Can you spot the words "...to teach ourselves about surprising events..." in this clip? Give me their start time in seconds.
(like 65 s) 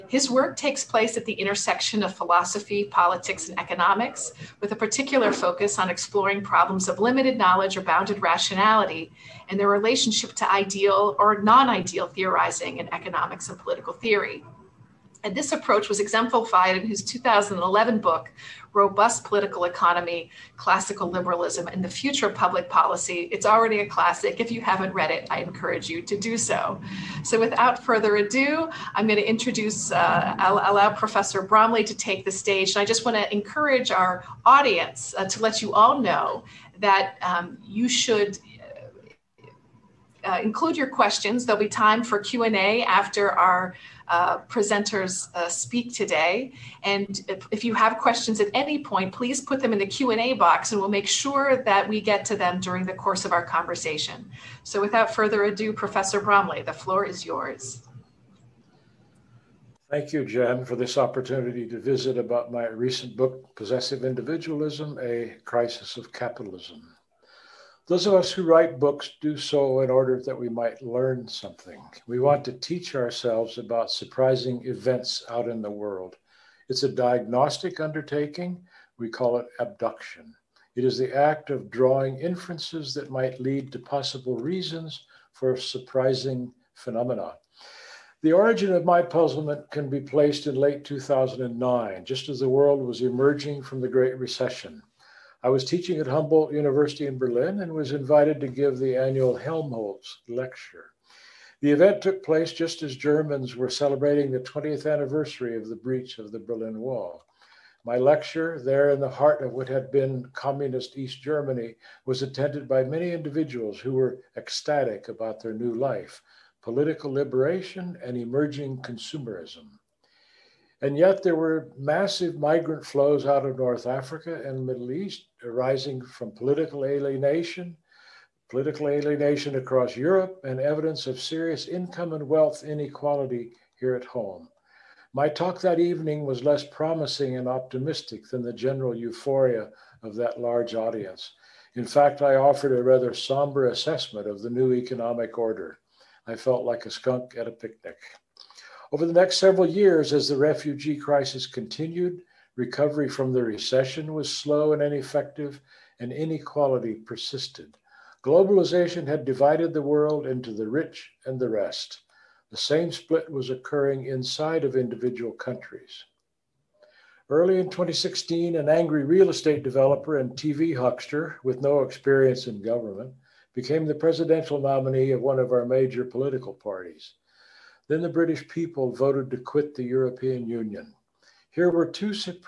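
72 s.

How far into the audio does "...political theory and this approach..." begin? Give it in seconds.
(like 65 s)
13 s.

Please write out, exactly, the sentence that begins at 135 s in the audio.
My talk that evening was less promising and optimistic than the general euphoria of that large audience.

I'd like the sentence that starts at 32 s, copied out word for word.
And I just want to encourage our audience uh, to let you all know that um, you should uh, include your questions.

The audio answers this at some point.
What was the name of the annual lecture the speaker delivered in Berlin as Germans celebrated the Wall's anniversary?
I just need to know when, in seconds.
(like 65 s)
99 s.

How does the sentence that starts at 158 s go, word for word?
Globalization had divided the world into the rich and the rest.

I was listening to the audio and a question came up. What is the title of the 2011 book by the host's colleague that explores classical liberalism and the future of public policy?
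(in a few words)
Robust Political Economy.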